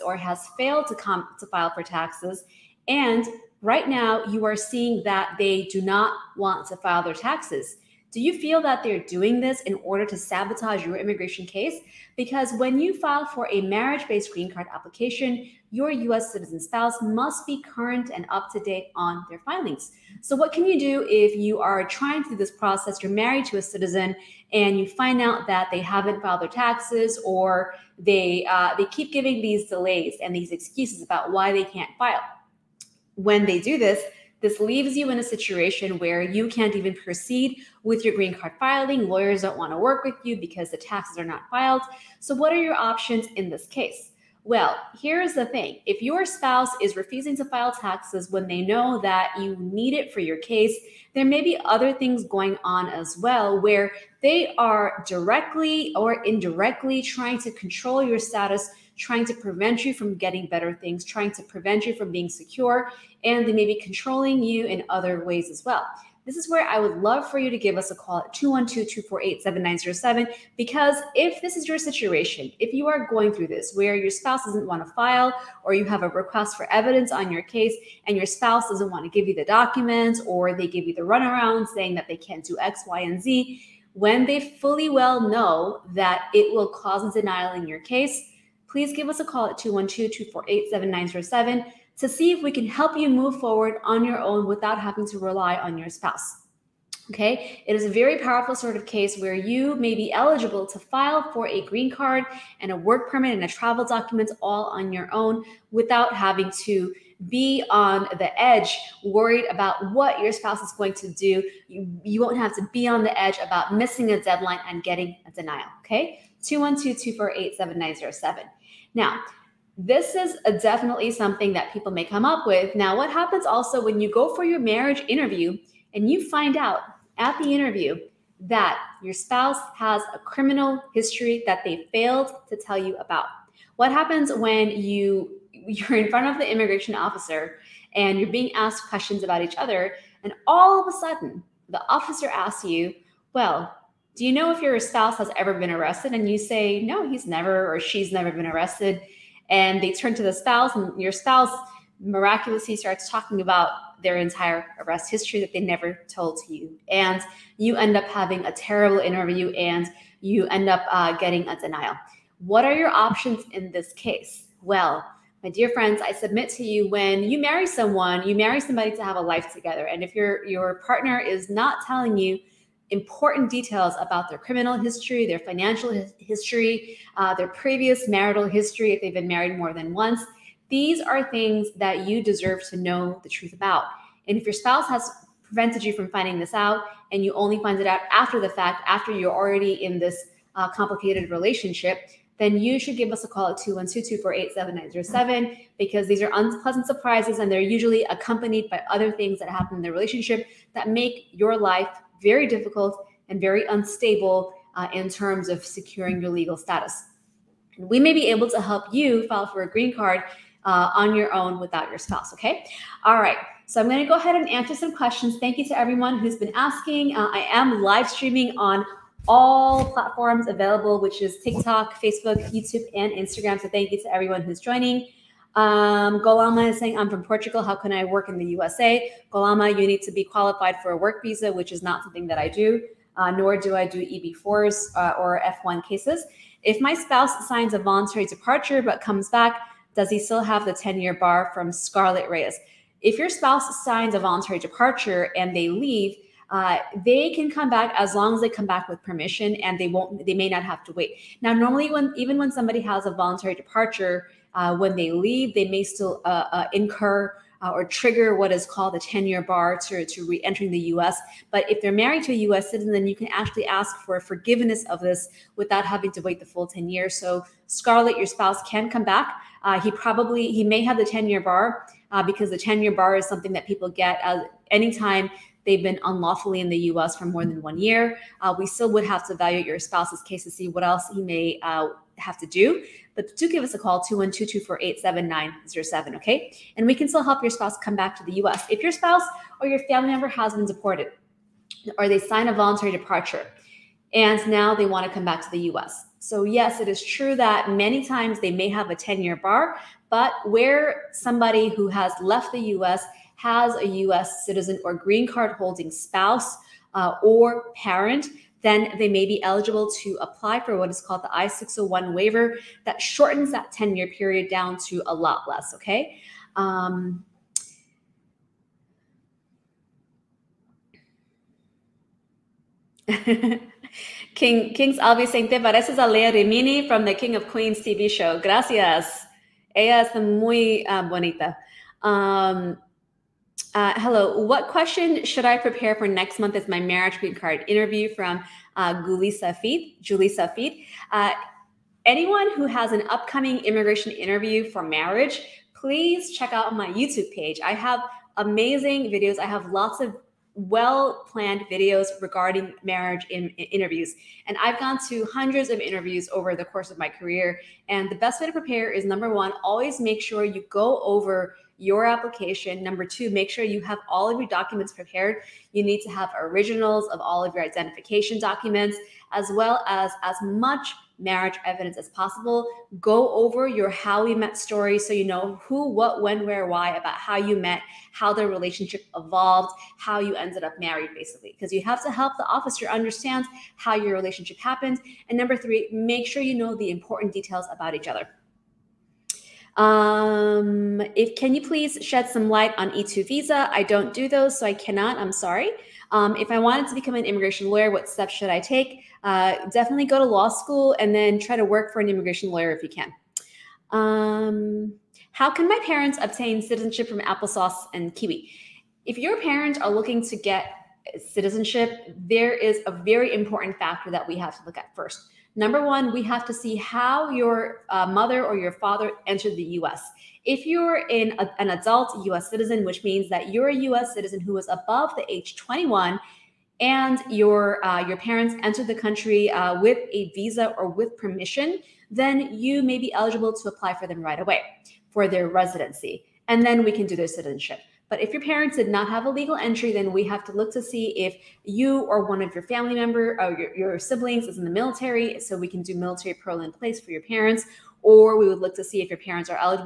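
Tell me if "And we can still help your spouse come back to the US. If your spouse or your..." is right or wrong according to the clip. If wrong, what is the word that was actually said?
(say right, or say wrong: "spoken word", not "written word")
right.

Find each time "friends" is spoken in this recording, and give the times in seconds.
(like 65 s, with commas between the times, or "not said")
165 s.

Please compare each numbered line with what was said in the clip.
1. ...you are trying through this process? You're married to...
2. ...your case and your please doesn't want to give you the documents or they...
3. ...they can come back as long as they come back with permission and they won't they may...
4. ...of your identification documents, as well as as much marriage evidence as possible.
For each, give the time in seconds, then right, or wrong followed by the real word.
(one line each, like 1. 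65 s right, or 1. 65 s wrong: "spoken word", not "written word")
1. 21 s right
2. 77 s wrong: "spouse", not "please"
3. 247 s right
4. 367 s right.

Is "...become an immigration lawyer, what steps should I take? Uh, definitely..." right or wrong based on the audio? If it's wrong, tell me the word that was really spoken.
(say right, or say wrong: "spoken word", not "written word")
right.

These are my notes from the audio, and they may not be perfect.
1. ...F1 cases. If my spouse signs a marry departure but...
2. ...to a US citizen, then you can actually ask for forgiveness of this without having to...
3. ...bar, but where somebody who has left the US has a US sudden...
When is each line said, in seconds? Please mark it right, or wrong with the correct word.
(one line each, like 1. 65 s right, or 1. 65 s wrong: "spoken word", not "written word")
1. 235 s wrong: "voluntary", not "marry"
2. 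262 s right
3. 299 s wrong: "citizen", not "sudden".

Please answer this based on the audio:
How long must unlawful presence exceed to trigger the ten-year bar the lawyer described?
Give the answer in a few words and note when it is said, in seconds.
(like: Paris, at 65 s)
1 year, at 277 s.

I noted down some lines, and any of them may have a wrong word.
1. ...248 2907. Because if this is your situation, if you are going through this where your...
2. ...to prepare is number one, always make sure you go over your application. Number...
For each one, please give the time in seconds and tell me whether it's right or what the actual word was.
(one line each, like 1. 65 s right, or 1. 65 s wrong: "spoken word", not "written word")
1. 68 s wrong: "7907", not "2907"
2. 358 s right.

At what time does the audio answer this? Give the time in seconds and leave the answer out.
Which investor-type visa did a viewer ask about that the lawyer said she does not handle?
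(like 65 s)
392 s.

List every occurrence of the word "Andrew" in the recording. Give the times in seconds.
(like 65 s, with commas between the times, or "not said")
not said.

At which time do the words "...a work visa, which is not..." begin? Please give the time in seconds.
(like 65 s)
230 s.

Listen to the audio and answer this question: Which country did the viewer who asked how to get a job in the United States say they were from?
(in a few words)
Portugal.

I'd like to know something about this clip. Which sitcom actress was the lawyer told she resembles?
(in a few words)
Leah Remini.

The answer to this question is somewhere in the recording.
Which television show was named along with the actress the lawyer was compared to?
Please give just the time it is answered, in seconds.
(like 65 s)
327 s.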